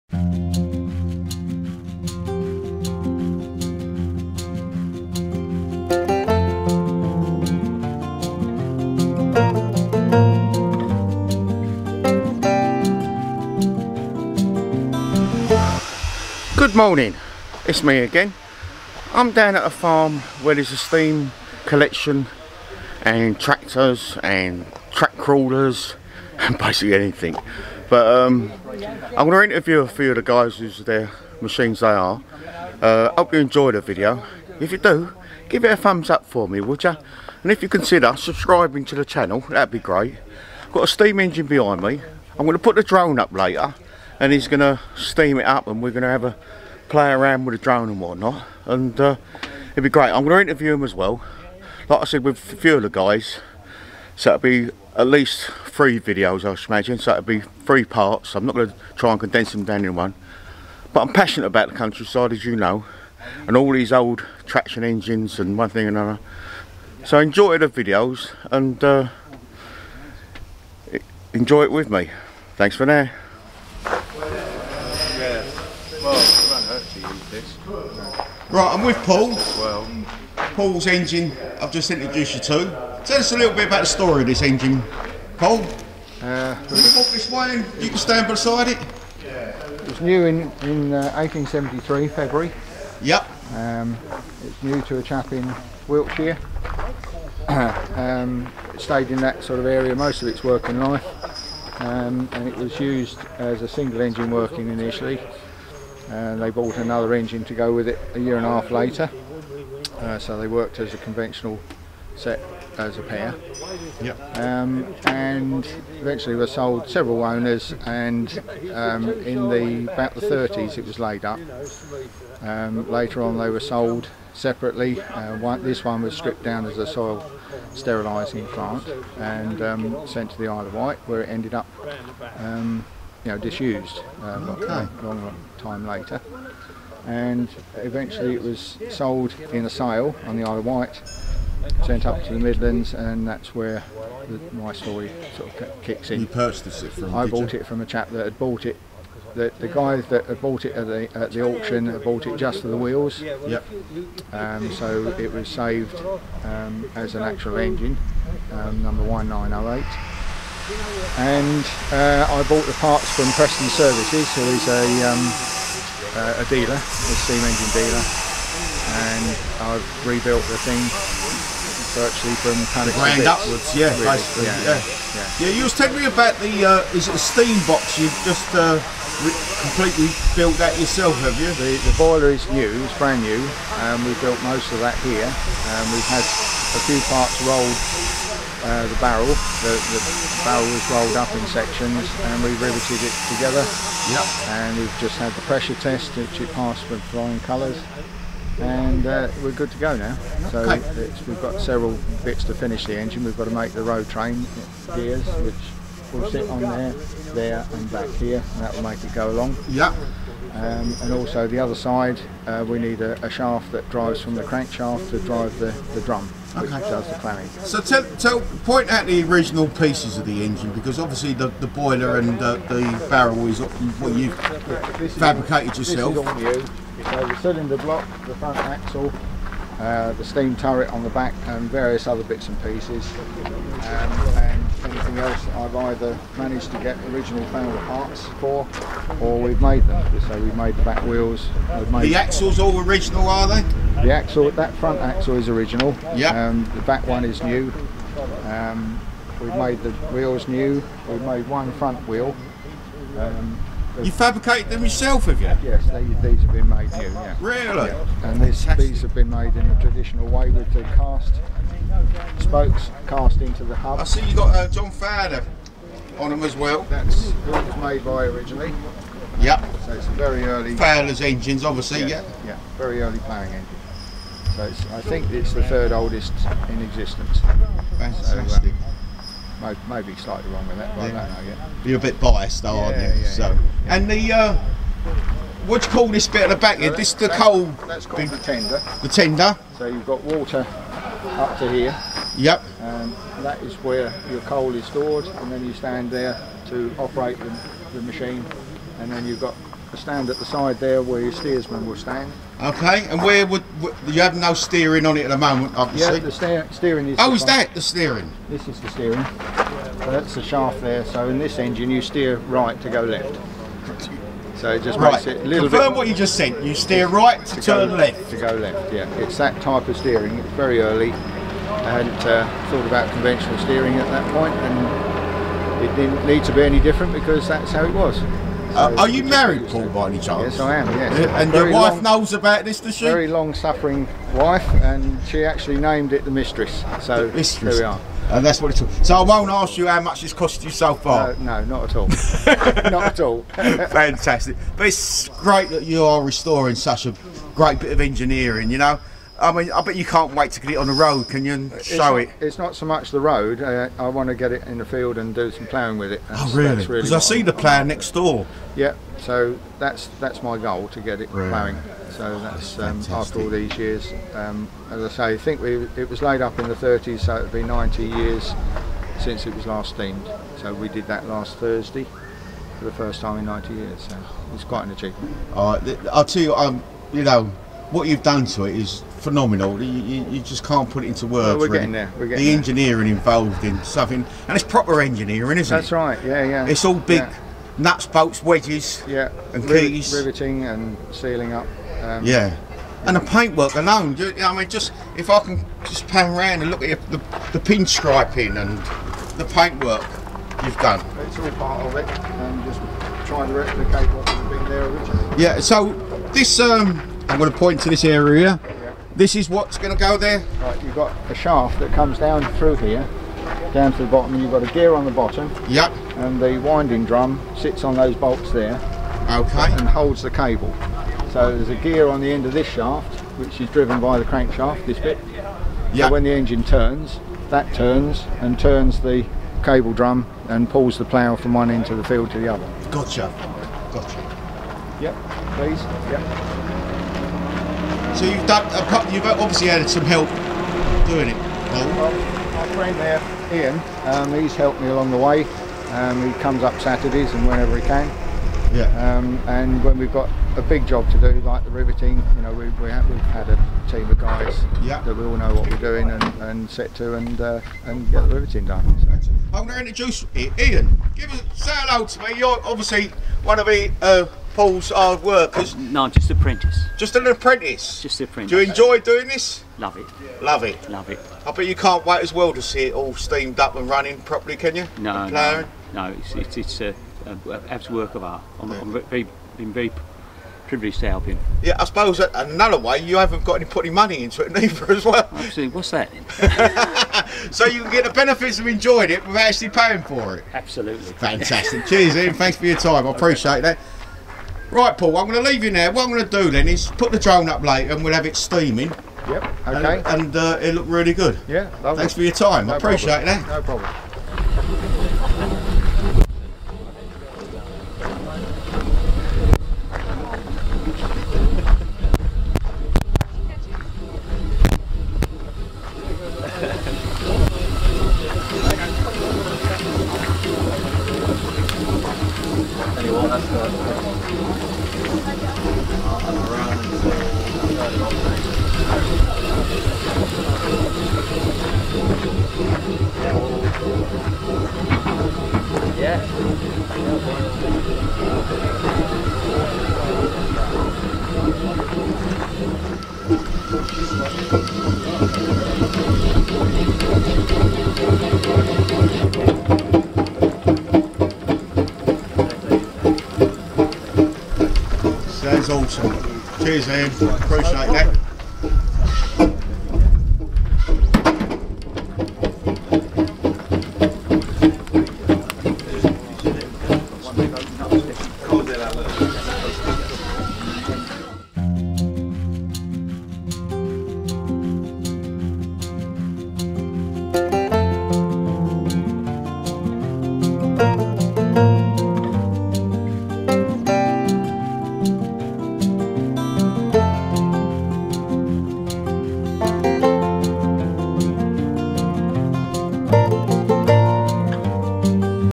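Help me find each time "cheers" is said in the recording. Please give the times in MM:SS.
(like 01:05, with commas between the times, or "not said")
08:11, 09:16.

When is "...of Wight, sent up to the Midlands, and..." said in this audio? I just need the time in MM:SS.
02:20.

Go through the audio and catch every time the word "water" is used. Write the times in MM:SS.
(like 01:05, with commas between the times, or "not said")
04:50.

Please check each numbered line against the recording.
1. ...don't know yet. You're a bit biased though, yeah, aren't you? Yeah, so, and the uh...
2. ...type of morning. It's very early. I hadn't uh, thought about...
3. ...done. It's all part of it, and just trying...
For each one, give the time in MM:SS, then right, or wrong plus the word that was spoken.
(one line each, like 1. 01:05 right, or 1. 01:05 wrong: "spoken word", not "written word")
1. 04:41 right
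2. 05:19 wrong: "steering", not "morning"
3. 06:40 right.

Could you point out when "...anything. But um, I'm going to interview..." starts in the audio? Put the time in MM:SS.
00:26.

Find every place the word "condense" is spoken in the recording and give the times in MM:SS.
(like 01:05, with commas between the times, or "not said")
00:59.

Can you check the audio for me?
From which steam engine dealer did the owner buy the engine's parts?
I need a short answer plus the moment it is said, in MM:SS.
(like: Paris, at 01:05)
Preston Services, at 02:43.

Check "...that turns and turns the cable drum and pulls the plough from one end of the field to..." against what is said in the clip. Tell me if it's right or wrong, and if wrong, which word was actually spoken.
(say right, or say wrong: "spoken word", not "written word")
right.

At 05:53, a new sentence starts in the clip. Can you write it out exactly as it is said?
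Uh, I want to get it in the field and do some ploughing with it.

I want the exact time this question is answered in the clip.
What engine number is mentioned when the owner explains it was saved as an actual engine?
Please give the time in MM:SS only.
02:39.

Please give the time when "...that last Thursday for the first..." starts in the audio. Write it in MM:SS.
06:11.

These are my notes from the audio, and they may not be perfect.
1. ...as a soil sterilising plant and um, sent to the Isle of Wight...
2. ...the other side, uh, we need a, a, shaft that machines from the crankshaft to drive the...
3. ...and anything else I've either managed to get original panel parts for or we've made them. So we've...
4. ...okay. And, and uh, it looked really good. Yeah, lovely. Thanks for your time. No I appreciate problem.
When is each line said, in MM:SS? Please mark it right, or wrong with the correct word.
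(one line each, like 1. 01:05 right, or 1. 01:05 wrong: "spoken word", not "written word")
1. 02:06 right
2. 03:31 wrong: "drives", not "machines"
3. 03:53 right
4. 08:19 right.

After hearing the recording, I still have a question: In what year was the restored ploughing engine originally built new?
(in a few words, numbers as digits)
1873.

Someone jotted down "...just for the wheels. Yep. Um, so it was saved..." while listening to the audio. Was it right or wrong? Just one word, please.
right.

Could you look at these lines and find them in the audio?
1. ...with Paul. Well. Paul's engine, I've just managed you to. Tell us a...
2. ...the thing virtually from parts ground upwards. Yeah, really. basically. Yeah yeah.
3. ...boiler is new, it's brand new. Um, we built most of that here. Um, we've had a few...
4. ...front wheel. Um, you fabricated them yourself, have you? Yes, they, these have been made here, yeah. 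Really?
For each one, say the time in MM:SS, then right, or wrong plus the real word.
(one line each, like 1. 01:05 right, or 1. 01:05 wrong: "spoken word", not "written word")
1. 01:18 wrong: "introduced", not "managed"
2. 02:50 wrong: "pallets", not "parts"
3. 03:01 right
4. 04:11 right.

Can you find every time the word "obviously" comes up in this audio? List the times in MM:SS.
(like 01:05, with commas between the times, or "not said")
03:40, 04:31, 05:05, 07:19, 07:42.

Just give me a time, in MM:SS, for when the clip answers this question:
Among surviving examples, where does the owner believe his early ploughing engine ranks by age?
04:35.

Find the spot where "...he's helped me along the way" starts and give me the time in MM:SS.
07:24.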